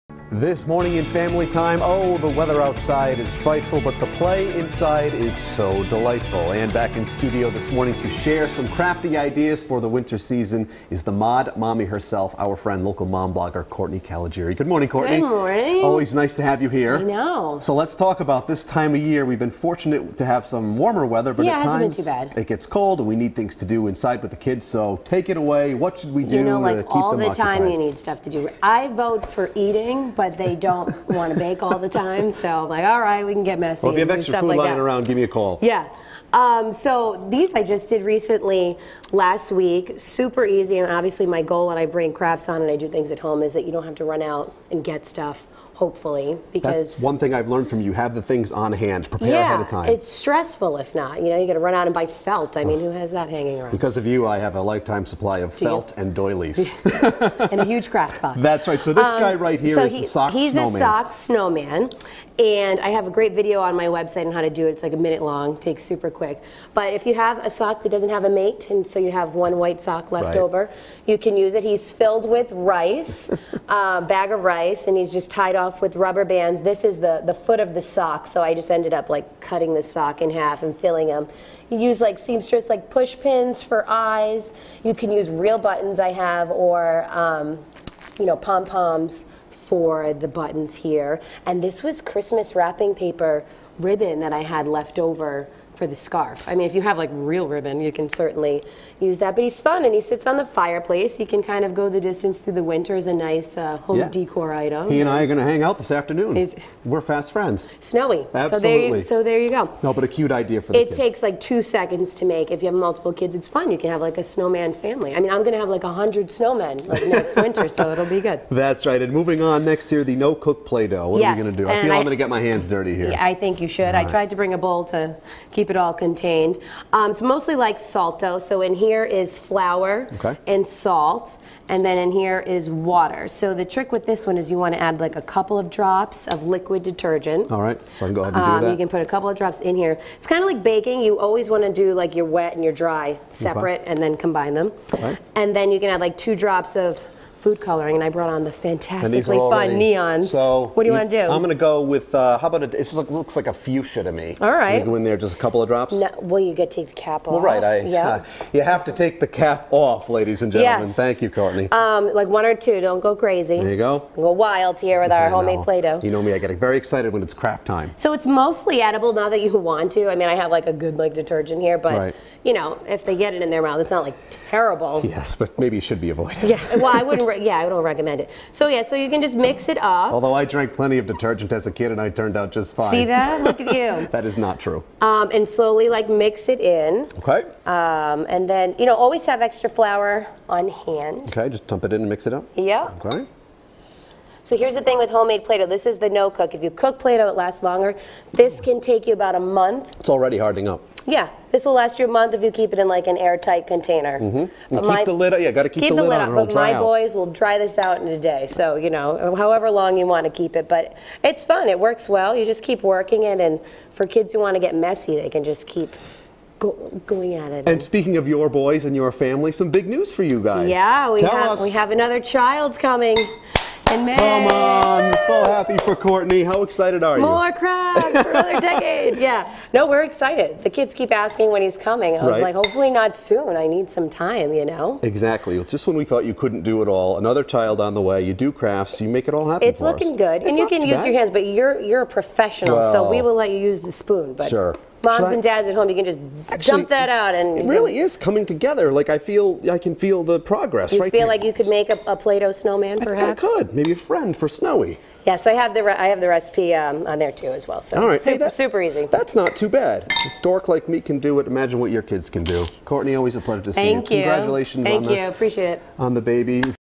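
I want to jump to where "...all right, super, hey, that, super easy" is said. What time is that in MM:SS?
04:18.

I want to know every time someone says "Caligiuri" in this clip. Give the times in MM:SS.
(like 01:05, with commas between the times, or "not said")
00:13.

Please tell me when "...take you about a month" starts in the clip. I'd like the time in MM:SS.
03:18.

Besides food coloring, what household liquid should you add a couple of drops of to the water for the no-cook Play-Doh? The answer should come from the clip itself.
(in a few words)
Liquid detergent.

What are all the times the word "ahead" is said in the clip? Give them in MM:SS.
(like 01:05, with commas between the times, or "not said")
00:49, 02:18.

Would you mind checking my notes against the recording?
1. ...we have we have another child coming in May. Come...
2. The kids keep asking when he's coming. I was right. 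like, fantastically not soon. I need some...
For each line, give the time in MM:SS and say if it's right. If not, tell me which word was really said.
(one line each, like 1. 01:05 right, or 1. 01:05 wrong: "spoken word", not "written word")
1. 03:41 right
2. 03:50 wrong: "hopefully", not "fantastically".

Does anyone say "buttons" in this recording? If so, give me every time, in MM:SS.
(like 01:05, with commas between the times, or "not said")
01:25, 01:30.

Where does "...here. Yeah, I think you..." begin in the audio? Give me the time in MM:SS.
02:02.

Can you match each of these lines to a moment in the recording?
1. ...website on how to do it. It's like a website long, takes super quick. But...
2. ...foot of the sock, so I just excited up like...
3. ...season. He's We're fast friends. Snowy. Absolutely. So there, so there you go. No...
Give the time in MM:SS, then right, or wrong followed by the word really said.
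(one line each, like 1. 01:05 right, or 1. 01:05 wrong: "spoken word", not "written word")
1. 01:03 wrong: "minute", not "website"
2. 01:17 wrong: "ended", not "excited"
3. 01:45 wrong: "afternoon", not "season".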